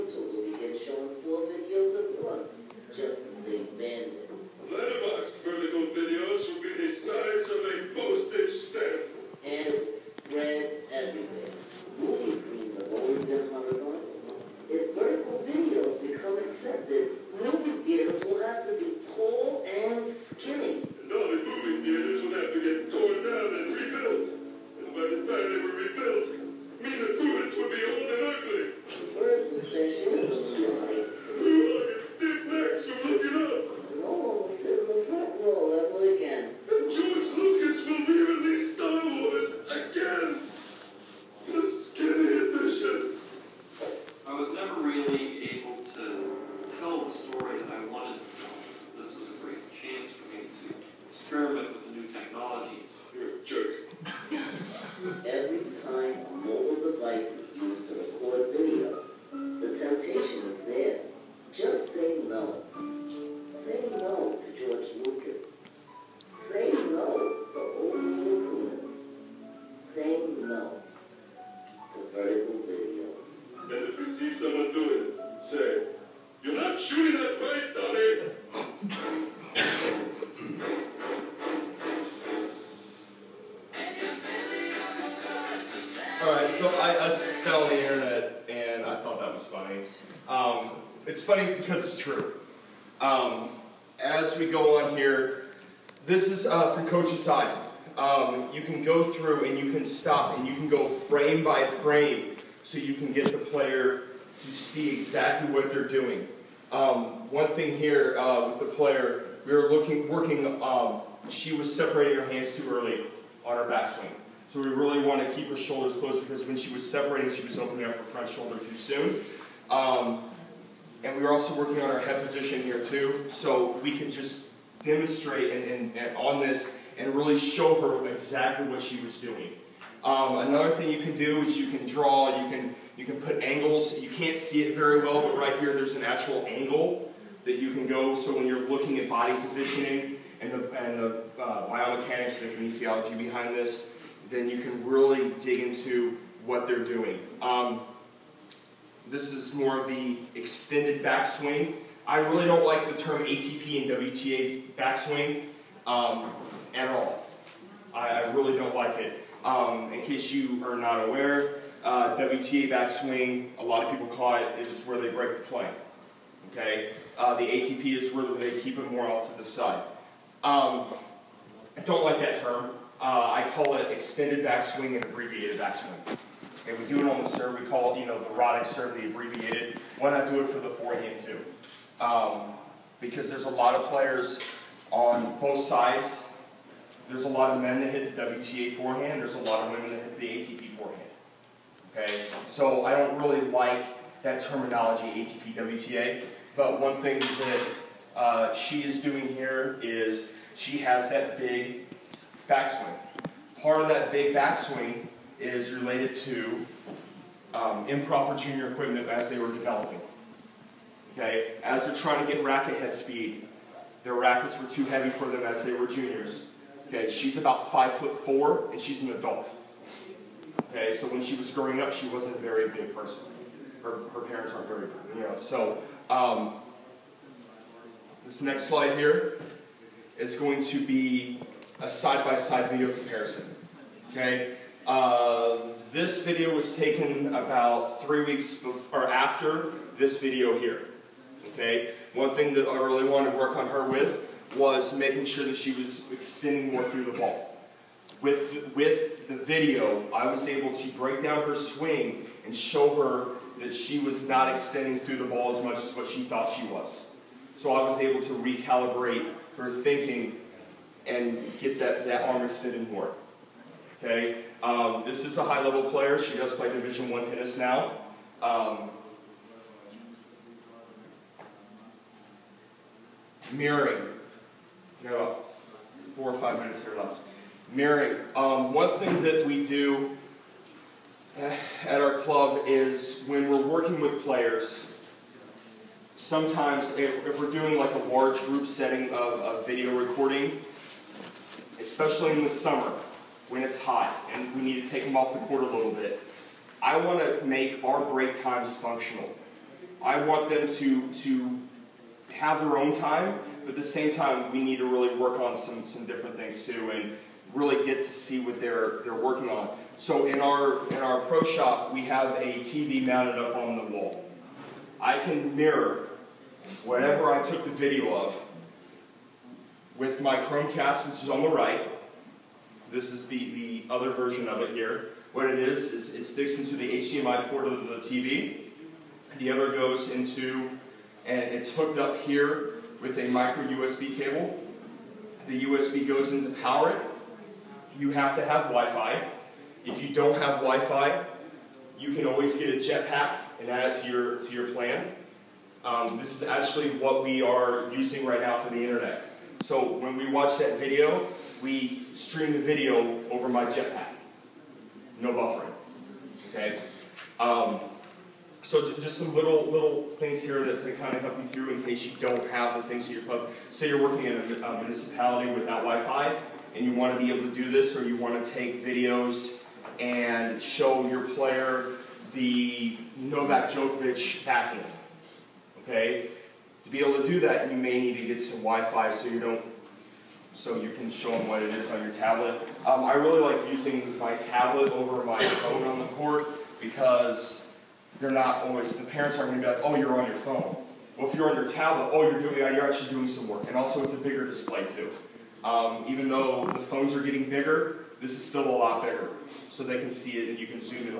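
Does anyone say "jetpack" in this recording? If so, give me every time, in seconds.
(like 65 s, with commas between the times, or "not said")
342 s, 353 s.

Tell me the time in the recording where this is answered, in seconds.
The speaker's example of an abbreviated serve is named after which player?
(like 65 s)
178 s.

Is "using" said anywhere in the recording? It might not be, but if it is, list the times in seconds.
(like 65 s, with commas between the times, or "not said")
347 s, 383 s.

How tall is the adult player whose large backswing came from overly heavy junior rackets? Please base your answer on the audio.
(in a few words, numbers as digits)
5 foot 4.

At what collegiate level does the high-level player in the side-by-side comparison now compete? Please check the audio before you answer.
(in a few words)
Division One.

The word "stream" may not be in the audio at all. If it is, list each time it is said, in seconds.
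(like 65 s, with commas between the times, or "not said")
352 s.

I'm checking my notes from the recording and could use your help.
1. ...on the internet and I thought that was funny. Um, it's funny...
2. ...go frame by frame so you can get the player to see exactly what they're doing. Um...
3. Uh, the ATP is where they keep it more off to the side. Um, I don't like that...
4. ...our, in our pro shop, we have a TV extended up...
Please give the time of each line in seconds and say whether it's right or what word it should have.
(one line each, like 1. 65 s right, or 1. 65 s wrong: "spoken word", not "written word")
1. 87 s right
2. 100 s right
3. 167 s right
4. 310 s wrong: "mounted", not "extended".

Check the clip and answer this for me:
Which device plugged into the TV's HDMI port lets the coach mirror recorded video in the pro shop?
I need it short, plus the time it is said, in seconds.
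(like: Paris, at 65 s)
Chromecast, at 320 s.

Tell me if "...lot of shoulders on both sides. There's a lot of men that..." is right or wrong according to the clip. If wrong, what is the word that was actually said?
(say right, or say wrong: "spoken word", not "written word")
wrong: "players", not "shoulders".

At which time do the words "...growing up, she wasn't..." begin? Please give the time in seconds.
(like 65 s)
221 s.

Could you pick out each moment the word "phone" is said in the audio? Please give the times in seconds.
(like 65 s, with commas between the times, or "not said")
385 s, 390 s, 396 s.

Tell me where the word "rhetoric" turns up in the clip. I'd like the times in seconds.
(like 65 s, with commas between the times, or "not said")
not said.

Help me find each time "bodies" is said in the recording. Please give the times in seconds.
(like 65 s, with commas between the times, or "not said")
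not said.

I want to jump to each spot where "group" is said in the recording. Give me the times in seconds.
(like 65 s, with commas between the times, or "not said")
288 s.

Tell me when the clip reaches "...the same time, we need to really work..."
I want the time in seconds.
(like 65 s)
303 s.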